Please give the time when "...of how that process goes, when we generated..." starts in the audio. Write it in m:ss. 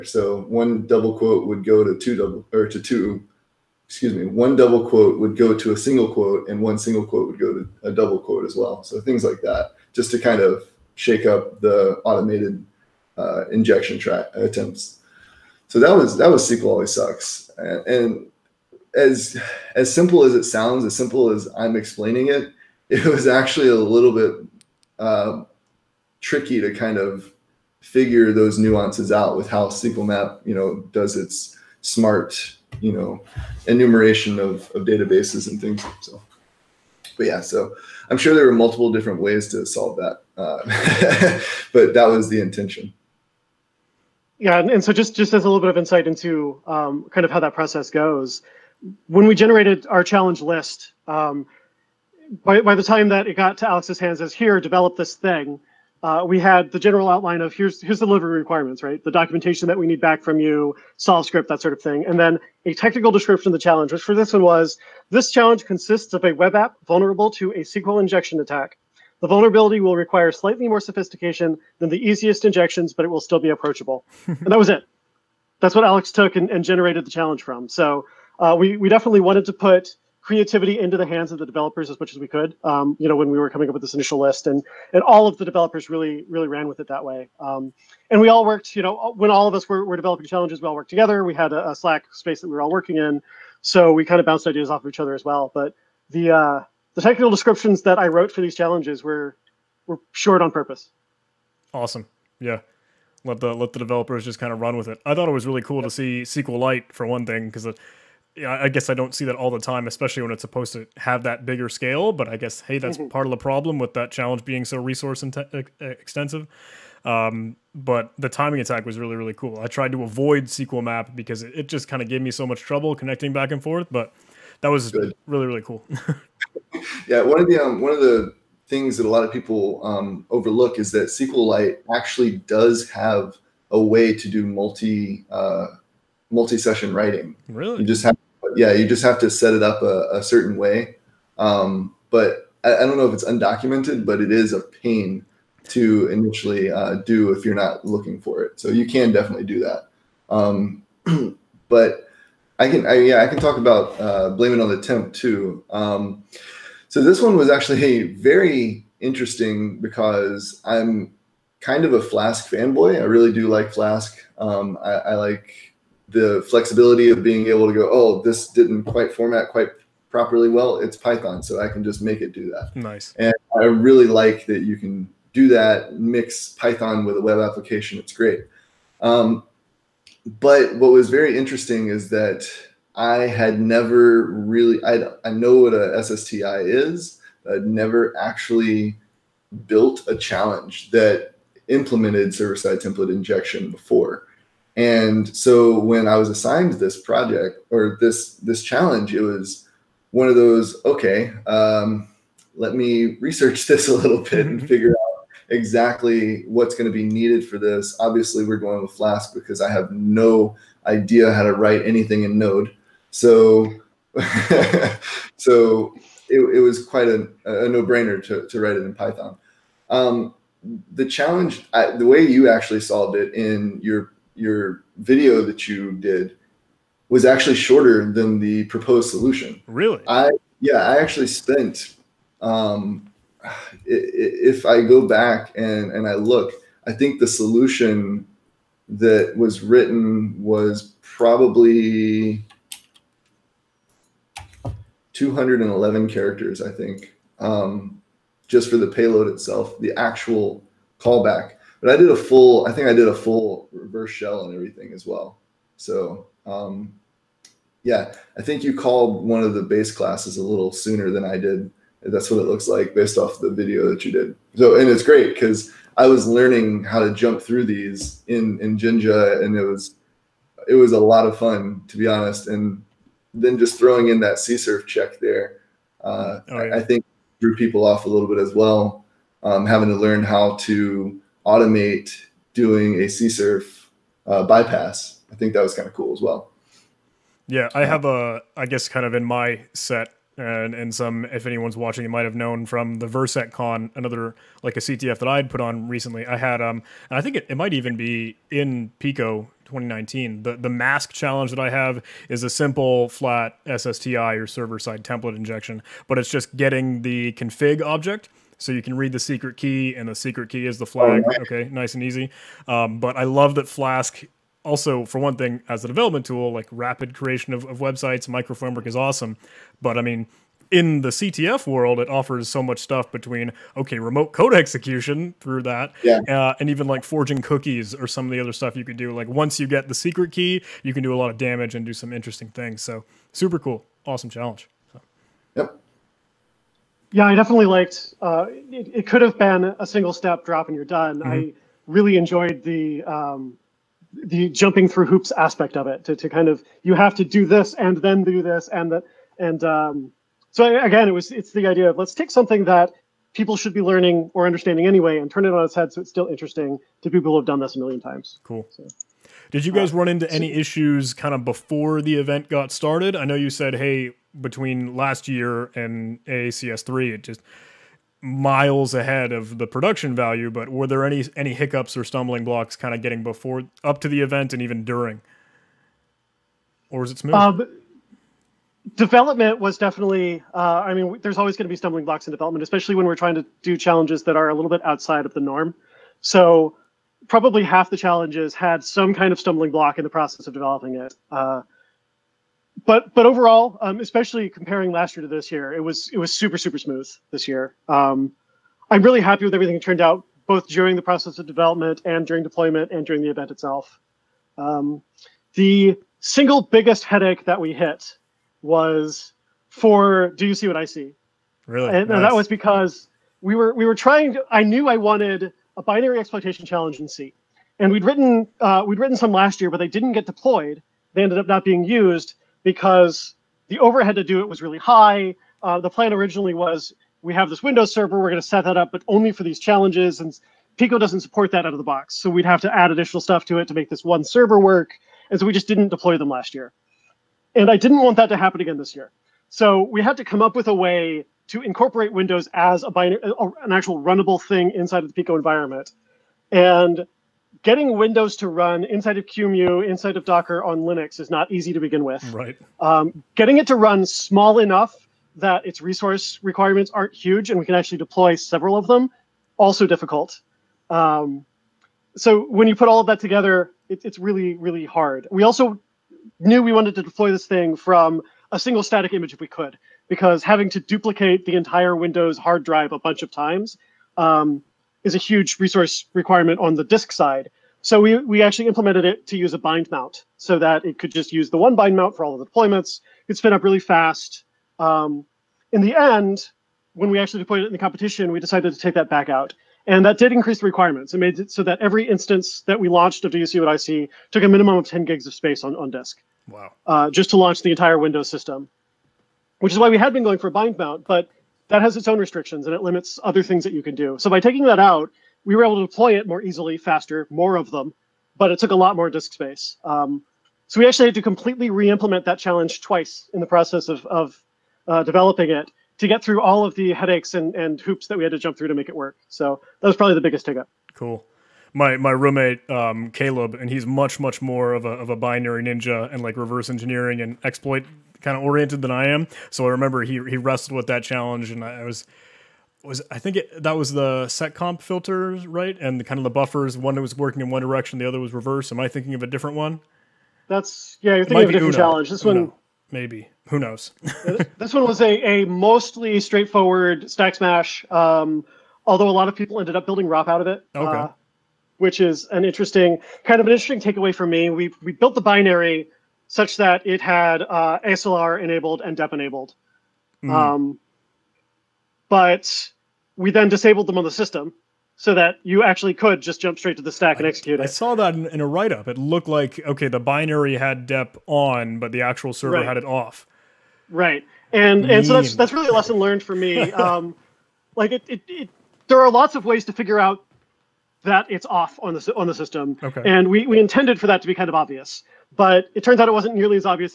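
0:47.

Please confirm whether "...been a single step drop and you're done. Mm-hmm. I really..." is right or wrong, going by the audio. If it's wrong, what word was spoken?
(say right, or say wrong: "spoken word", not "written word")
right.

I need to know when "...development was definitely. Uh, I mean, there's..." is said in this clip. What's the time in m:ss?
6:18.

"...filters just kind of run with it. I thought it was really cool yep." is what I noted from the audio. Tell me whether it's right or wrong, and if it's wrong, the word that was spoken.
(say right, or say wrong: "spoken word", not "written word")
wrong: "developers", not "filters".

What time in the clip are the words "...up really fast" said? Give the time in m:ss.
8:03.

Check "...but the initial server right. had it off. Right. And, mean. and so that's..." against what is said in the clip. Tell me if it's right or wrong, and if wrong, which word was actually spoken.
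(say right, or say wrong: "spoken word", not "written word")
wrong: "actual", not "initial".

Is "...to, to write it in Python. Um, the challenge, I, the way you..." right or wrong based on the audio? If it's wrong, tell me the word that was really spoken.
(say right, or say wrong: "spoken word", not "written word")
right.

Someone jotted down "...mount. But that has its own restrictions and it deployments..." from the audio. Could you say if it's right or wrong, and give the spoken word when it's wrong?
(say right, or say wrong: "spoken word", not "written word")
wrong: "limits", not "deployments".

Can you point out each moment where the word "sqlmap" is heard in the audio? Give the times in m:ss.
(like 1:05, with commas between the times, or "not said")
0:29, 2:00.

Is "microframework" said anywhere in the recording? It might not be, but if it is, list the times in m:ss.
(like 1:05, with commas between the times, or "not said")
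5:18.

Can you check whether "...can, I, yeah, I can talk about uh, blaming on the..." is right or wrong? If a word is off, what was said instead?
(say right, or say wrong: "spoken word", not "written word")
right.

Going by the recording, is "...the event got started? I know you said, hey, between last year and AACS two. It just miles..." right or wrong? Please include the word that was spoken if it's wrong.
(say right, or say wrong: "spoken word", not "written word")
wrong: "three", not "two".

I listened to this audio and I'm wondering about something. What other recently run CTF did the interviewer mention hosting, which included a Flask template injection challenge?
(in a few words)
VirSecCon.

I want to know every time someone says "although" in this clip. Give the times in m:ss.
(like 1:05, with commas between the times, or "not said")
9:08.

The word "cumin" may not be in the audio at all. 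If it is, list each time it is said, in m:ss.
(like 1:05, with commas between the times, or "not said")
not said.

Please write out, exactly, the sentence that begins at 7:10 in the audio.
And Pico doesn't support that out of the box.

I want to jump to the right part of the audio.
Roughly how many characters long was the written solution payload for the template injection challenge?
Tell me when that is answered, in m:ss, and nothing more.
4:05.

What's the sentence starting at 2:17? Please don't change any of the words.
Really, you just have yeah, you just have to set it up a, a certain way.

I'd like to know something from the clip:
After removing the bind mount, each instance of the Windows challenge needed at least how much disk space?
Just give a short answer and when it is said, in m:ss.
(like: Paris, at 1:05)
10 gigs, at 8:14.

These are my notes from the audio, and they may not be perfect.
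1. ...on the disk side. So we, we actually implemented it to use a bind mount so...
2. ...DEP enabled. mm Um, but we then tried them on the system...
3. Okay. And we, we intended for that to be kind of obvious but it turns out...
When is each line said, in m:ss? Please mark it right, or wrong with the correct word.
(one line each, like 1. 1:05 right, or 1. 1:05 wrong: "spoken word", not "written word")
1. 7:56 right
2. 9:18 wrong: "disabled", not "tried"
3. 9:42 right.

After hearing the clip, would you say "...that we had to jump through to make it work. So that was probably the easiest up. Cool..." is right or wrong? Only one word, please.
wrong.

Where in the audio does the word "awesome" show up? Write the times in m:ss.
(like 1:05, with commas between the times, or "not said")
1:41, 5:18, 5:34.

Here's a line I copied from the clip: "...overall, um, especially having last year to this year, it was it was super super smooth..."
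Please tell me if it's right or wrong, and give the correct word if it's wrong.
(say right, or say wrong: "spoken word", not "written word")
wrong: "comparing", not "having".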